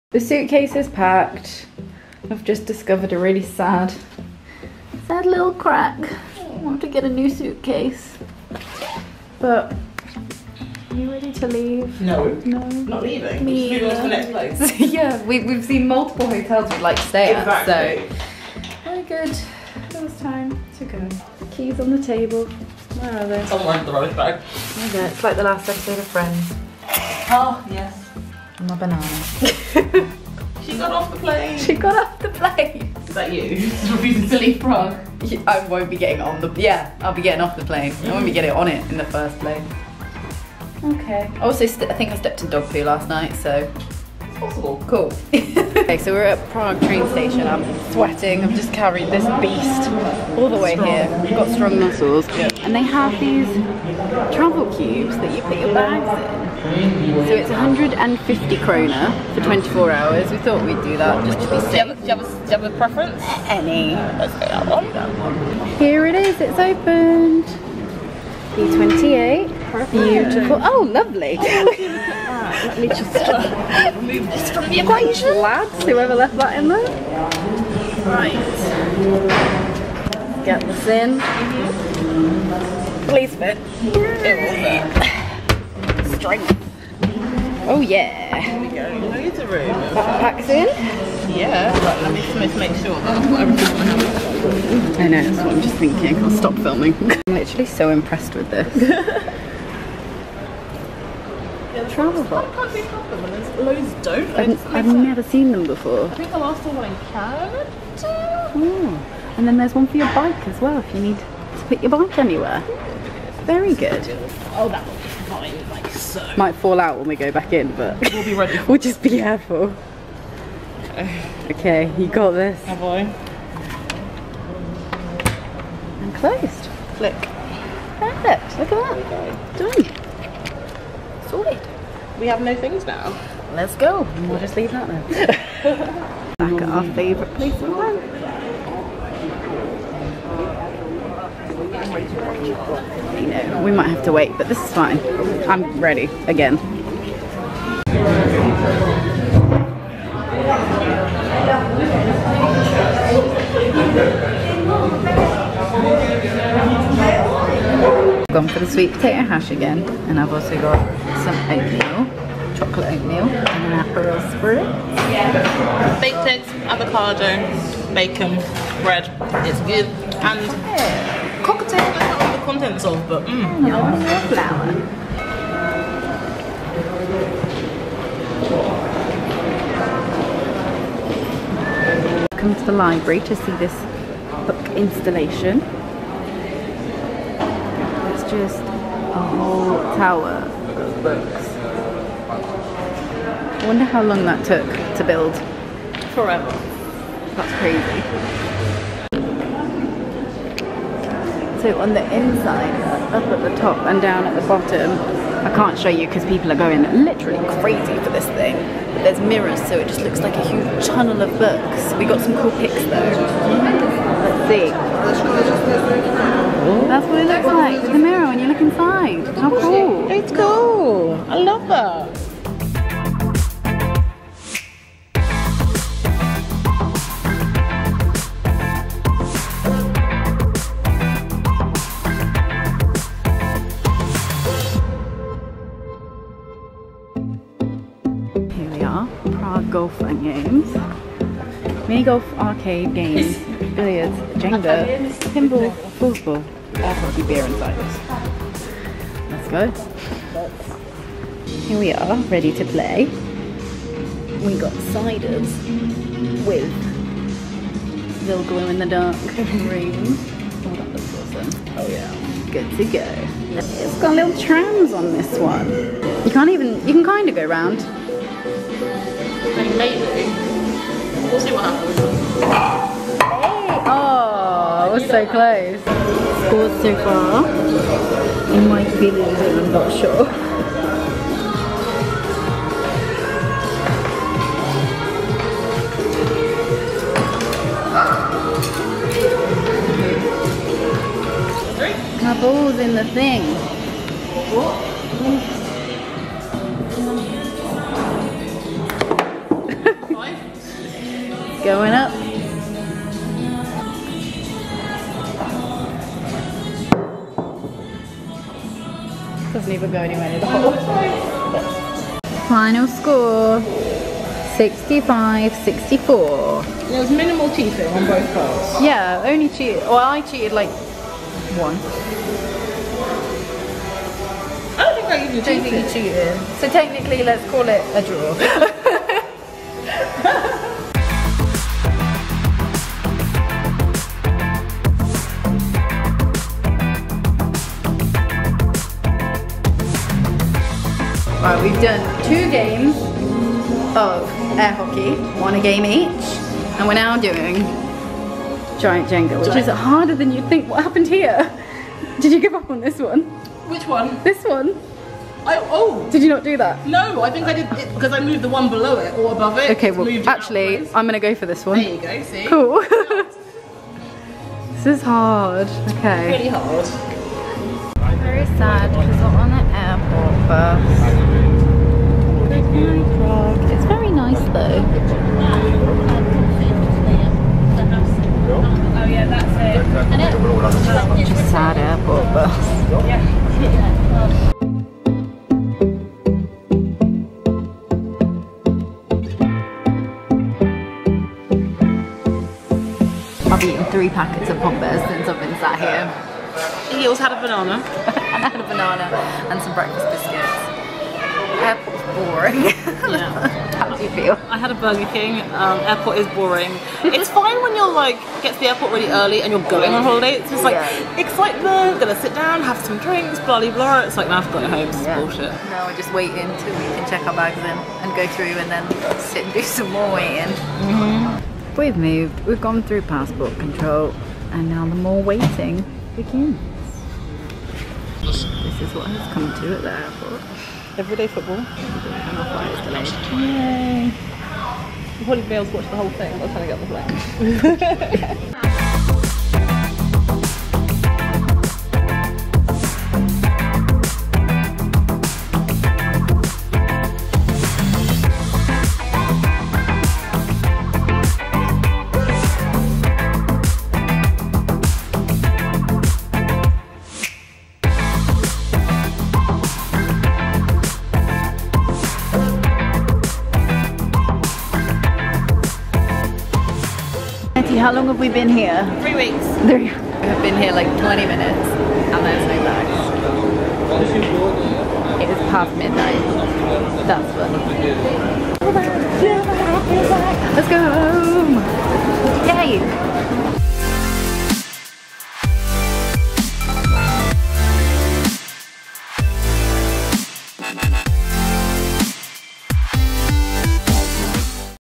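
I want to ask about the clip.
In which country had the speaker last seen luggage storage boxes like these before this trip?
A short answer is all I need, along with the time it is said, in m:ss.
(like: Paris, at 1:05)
Canada, at 1:47.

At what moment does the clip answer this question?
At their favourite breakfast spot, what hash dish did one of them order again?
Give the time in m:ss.
2:38.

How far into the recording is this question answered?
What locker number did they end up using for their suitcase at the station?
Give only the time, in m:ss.
1:08.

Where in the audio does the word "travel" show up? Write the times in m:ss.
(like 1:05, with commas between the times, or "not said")
0:54, 1:41.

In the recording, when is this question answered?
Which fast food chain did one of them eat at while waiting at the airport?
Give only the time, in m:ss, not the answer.
6:44.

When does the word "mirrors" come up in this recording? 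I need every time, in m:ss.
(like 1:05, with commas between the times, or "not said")
3:29, 3:37.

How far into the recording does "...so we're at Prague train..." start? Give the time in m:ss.
0:45.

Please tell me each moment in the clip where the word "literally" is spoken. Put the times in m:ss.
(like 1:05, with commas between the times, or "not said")
1:37, 3:27.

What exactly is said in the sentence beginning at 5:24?
I don't think I even cheated.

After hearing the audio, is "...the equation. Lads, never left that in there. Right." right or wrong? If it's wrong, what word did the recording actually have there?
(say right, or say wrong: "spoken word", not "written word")
wrong: "whoever", not "never".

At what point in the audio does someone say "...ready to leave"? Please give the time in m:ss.
0:11.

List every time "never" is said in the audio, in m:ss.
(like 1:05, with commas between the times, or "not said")
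1:44, 5:09.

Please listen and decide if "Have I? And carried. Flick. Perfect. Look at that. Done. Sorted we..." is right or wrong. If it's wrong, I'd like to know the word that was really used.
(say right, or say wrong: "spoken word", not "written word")
wrong: "closed", not "carried".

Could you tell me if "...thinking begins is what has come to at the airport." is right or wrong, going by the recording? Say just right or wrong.
wrong.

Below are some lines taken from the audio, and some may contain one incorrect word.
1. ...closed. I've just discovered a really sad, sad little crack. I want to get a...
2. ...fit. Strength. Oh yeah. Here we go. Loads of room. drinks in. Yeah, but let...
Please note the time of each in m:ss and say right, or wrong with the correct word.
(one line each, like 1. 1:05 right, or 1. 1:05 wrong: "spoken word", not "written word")
1. 0:00 wrong: "packed", not "closed"
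2. 1:26 wrong: "packs", not "drinks".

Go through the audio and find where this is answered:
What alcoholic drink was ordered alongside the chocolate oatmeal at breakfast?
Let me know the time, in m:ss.
2:43.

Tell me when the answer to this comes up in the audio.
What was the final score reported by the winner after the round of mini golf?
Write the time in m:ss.
5:14.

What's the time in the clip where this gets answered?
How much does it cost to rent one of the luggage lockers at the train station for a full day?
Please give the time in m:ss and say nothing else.
0:57.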